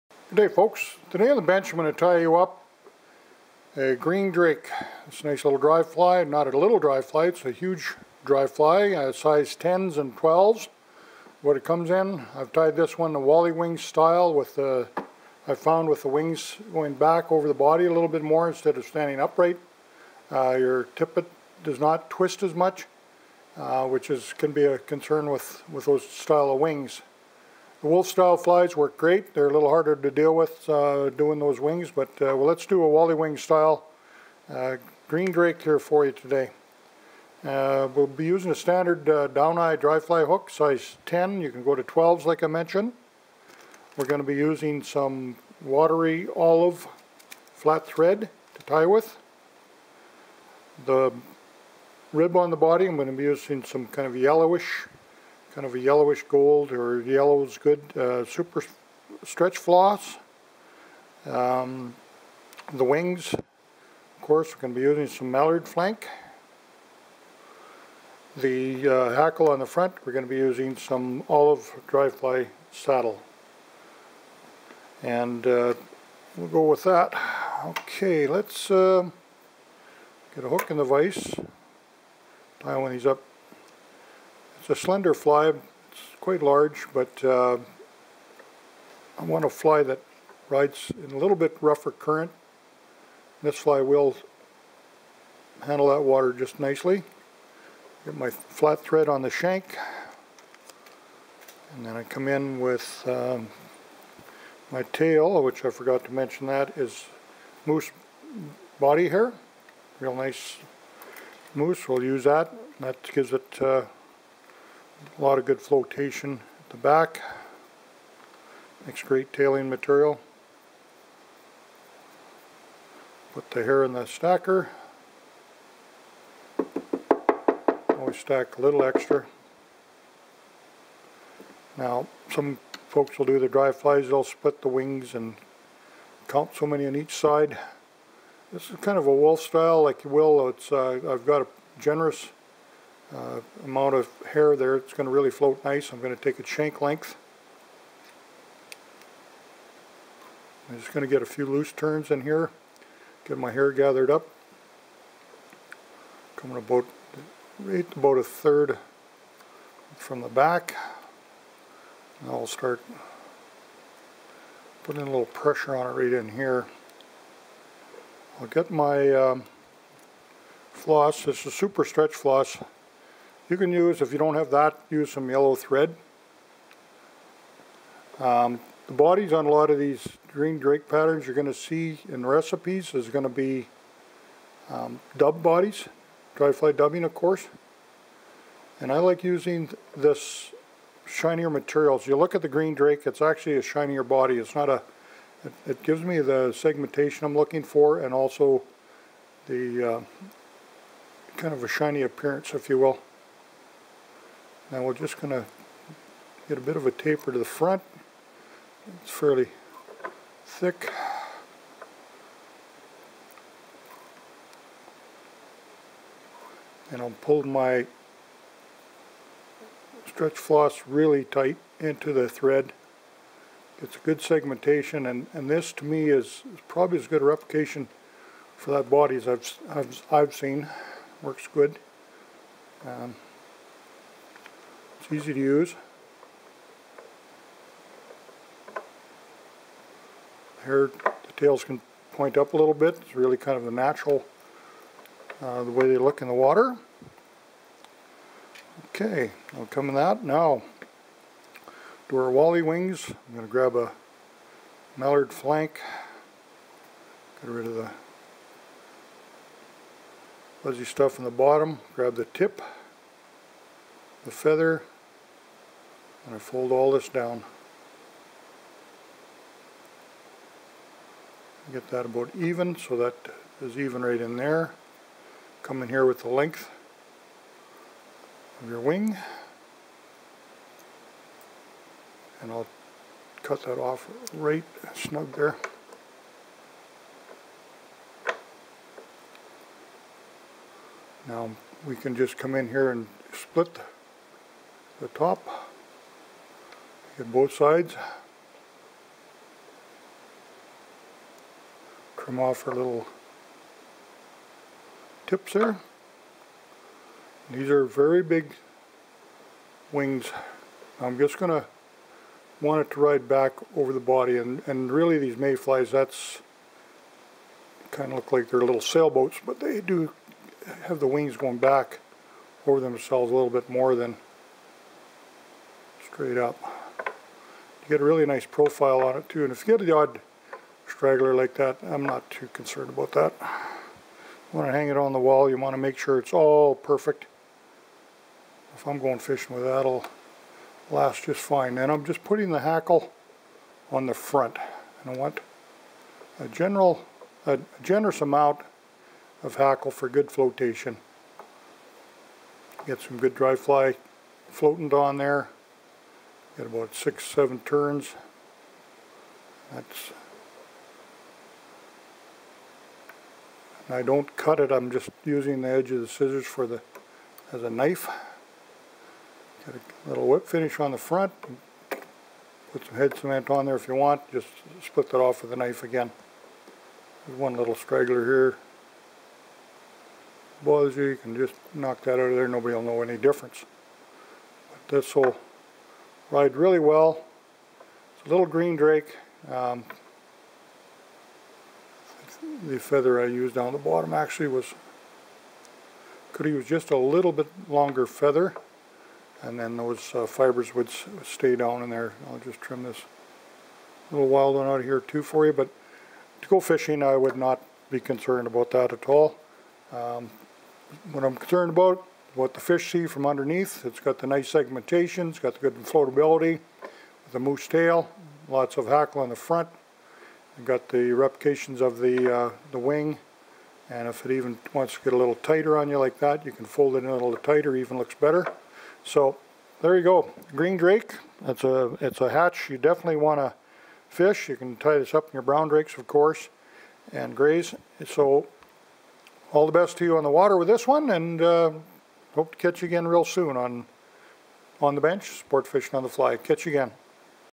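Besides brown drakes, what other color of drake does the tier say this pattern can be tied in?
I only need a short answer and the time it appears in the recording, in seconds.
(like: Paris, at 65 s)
grays, at 437 s.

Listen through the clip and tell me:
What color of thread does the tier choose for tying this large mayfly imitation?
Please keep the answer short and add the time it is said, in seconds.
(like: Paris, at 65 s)
watery olive, at 45 s.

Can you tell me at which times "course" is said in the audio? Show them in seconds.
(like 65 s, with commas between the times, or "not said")
64 s, 187 s, 436 s.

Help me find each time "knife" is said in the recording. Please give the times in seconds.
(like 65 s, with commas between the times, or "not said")
367 s, 375 s.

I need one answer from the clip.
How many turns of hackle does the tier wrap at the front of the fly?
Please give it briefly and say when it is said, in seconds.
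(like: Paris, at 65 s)
6 or 7, at 356 s.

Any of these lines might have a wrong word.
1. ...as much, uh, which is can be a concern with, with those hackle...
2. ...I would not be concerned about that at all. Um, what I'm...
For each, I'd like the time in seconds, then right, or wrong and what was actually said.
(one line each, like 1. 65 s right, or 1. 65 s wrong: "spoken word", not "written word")
1. 22 s wrong: "style", not "hackle"
2. 407 s right.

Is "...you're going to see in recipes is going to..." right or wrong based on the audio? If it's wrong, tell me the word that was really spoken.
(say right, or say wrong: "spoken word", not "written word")
right.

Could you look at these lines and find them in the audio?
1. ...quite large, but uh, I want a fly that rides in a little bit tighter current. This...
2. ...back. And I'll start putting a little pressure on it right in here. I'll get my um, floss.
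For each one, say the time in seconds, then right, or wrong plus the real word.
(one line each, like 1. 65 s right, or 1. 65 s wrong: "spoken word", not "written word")
1. 86 s wrong: "rougher", not "tighter"
2. 160 s right.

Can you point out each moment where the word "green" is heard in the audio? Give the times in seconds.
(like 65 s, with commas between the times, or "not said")
3 s, 35 s, 180 s, 192 s, 388 s, 430 s.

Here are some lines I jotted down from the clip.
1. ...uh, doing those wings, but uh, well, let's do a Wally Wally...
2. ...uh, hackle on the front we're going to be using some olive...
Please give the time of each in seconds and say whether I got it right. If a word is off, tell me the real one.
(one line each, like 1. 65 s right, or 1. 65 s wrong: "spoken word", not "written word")
1. 30 s wrong: "Wing", not "Wally"
2. 68 s right.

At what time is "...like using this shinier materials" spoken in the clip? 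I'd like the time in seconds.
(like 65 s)
188 s.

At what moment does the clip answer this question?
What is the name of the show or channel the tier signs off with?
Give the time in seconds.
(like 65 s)
445 s.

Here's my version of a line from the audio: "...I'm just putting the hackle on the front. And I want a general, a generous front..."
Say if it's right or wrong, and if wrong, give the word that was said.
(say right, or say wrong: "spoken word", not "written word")
wrong: "amount", not "front".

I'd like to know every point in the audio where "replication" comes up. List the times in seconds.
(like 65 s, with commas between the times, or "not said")
227 s, 421 s.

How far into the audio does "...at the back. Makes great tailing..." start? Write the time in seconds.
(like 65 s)
116 s.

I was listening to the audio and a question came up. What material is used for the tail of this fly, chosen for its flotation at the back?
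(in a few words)
moose body hair.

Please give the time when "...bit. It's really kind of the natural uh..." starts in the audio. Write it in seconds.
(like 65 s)
242 s.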